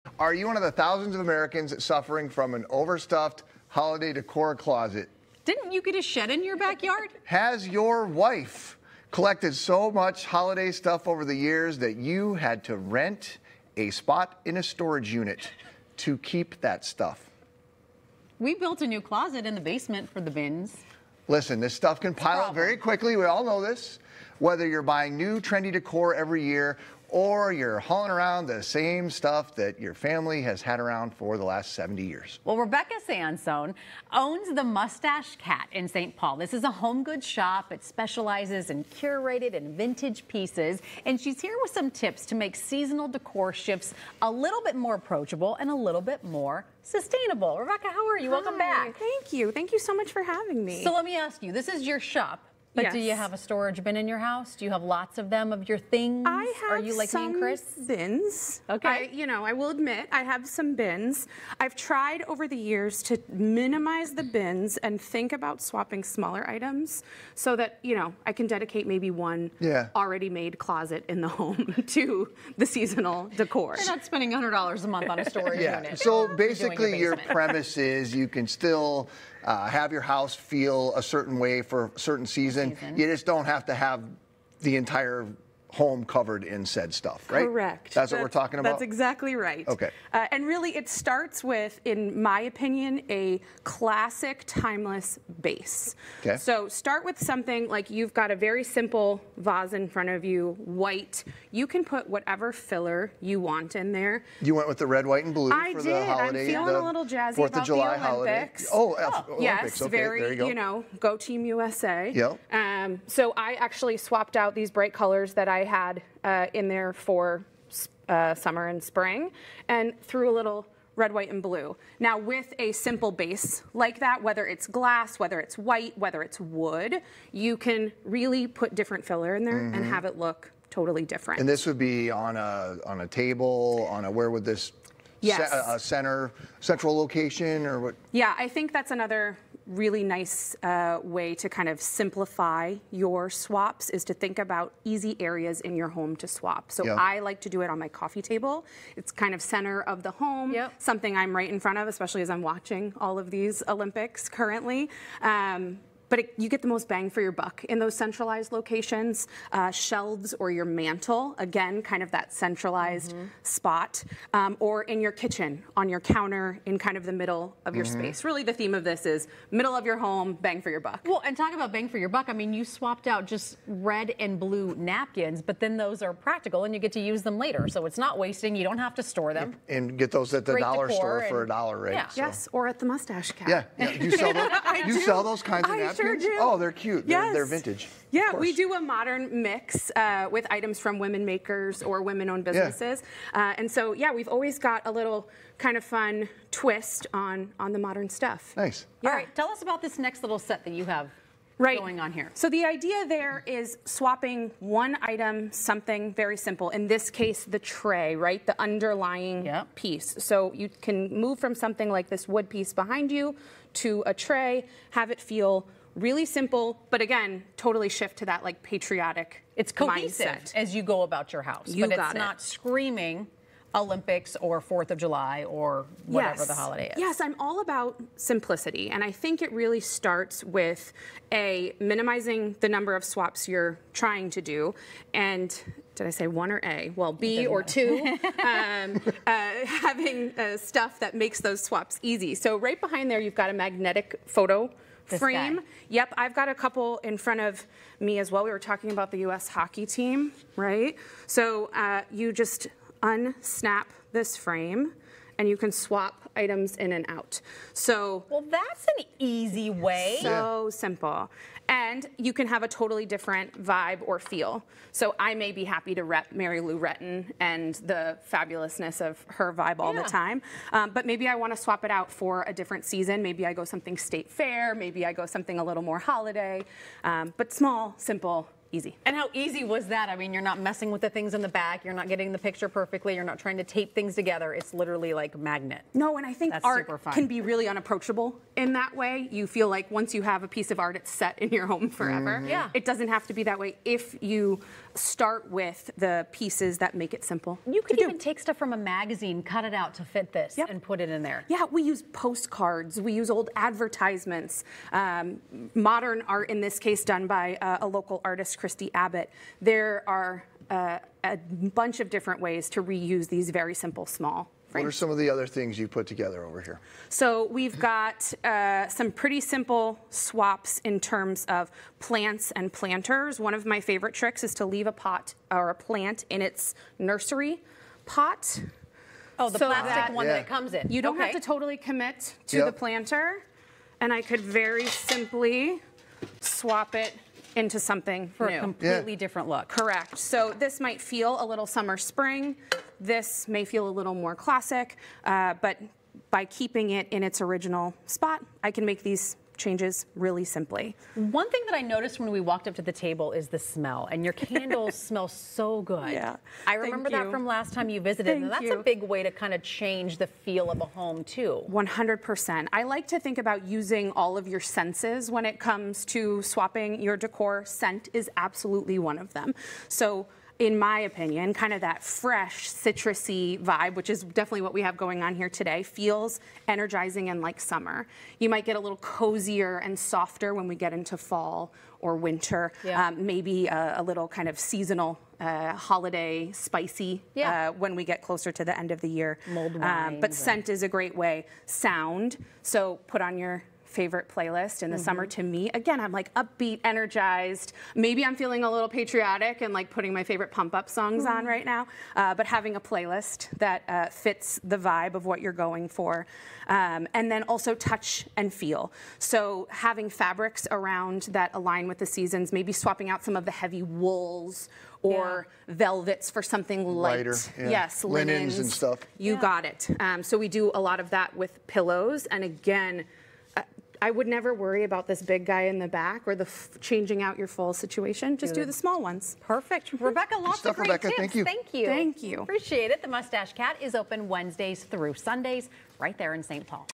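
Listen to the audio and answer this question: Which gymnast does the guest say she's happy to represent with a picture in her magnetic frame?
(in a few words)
Mary Lou Retton.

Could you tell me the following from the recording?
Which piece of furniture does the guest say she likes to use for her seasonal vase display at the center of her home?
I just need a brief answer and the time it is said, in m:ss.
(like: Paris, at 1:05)
Coffee table, at 2:27.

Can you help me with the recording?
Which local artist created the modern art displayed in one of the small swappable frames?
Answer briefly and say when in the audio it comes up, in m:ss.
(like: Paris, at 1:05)
Christy Abbott, at 5:08.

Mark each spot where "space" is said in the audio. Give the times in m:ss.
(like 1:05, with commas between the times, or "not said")
2:48.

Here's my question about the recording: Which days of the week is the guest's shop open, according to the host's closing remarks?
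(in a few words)
Wednesdays through Sundays.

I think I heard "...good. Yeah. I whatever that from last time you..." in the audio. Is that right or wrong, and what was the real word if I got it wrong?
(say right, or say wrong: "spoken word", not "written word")
wrong: "remember", not "whatever".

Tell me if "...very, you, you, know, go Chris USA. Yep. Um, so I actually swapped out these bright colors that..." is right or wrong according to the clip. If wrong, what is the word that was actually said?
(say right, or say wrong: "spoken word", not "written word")
wrong: "Team", not "Chris".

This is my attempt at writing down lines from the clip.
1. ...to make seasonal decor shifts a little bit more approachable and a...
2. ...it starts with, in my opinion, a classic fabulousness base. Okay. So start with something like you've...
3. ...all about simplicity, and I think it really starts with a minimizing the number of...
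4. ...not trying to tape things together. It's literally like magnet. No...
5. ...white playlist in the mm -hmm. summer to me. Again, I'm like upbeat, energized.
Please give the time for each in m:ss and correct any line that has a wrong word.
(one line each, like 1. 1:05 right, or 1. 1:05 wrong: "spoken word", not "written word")
1. 0:42 right
2. 1:30 wrong: "timeless", not "fabulousness"
3. 3:47 right
4. 4:43 right
5. 6:33 wrong: "favorite", not "white".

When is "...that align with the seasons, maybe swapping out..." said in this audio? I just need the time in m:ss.
6:51.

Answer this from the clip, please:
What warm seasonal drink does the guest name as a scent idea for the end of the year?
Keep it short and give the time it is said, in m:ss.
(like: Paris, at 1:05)
Mulled wine, at 6:29.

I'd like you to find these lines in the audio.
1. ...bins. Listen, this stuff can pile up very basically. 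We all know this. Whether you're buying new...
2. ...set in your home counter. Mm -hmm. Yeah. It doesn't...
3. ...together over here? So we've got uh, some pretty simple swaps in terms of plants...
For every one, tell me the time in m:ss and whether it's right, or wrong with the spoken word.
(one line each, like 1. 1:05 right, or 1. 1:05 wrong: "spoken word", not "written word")
1. 0:20 wrong: "quickly", not "basically"
2. 4:51 wrong: "forever", not "counter"
3. 5:16 right.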